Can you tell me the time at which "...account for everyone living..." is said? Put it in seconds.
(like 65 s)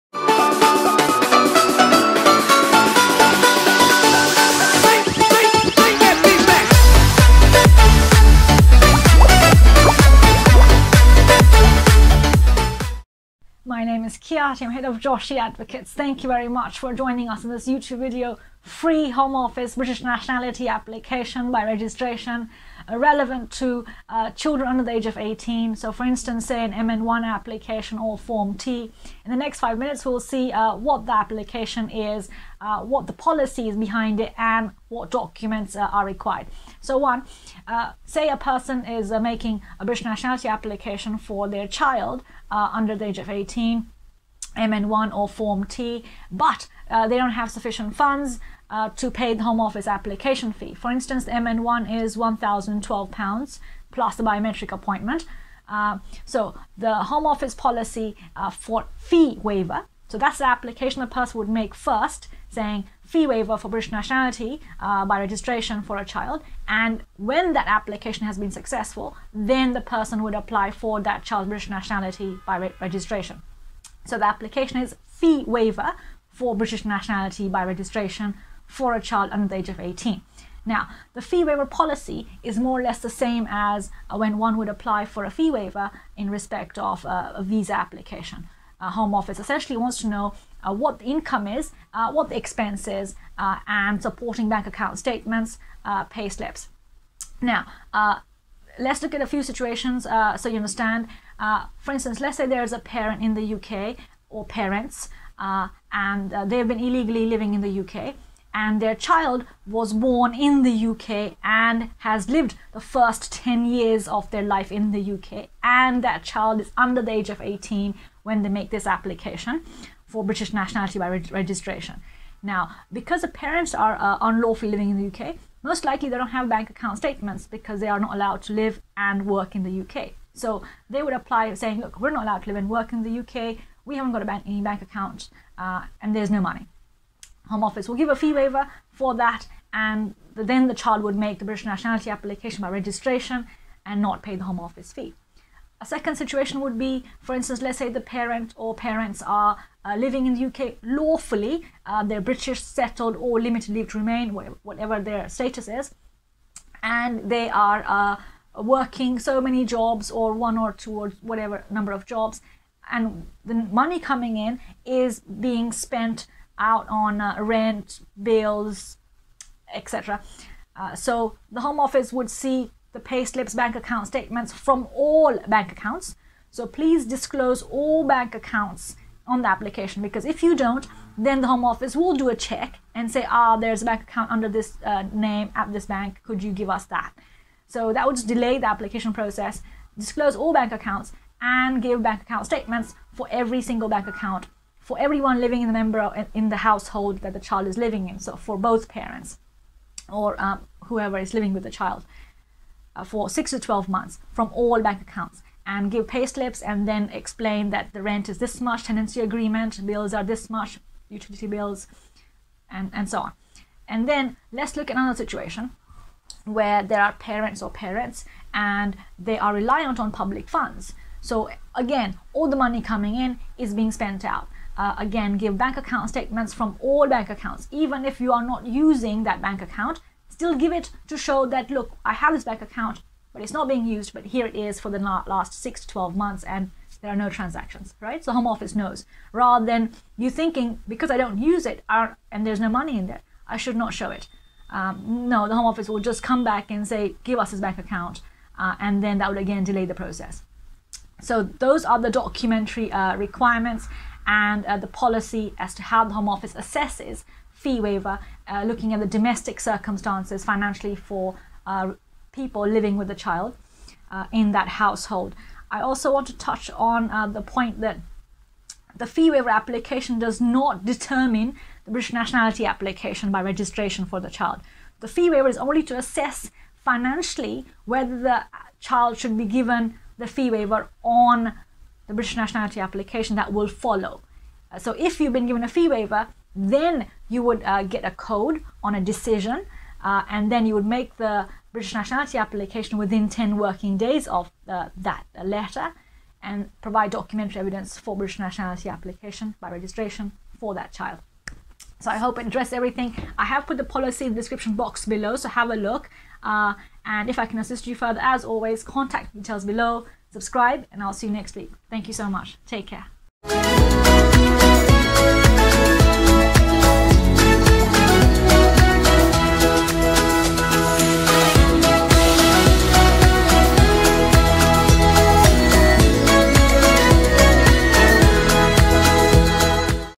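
194 s.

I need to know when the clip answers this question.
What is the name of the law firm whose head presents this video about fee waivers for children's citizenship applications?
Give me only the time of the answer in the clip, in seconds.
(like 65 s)
14 s.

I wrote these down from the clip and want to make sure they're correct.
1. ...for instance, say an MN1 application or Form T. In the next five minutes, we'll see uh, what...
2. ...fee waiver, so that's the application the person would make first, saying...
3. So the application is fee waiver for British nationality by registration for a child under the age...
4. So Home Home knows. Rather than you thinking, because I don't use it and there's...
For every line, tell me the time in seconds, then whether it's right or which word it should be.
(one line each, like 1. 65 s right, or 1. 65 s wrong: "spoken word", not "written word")
1. 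25 s right
2. 58 s right
3. 74 s right
4. 238 s wrong: "Office", not "Home".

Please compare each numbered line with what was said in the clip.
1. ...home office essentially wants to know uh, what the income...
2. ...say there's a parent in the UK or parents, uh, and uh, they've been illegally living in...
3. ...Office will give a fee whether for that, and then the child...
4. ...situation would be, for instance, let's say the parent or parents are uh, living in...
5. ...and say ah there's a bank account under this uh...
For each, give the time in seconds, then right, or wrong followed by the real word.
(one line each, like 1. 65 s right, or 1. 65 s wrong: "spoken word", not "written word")
1. 88 s right
2. 102 s right
3. 137 s wrong: "waiver", not "whether"
4. 146 s right
5. 182 s right.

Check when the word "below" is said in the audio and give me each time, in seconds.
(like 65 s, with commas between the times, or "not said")
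305 s, 309 s.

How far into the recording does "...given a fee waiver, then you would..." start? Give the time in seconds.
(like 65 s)
285 s.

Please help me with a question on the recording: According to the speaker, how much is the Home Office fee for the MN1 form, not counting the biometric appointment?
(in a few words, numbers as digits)
£1,012.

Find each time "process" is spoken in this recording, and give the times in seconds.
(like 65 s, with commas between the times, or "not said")
189 s, 249 s.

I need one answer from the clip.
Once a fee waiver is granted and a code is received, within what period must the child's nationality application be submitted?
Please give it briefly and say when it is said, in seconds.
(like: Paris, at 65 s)
10 working days, at 293 s.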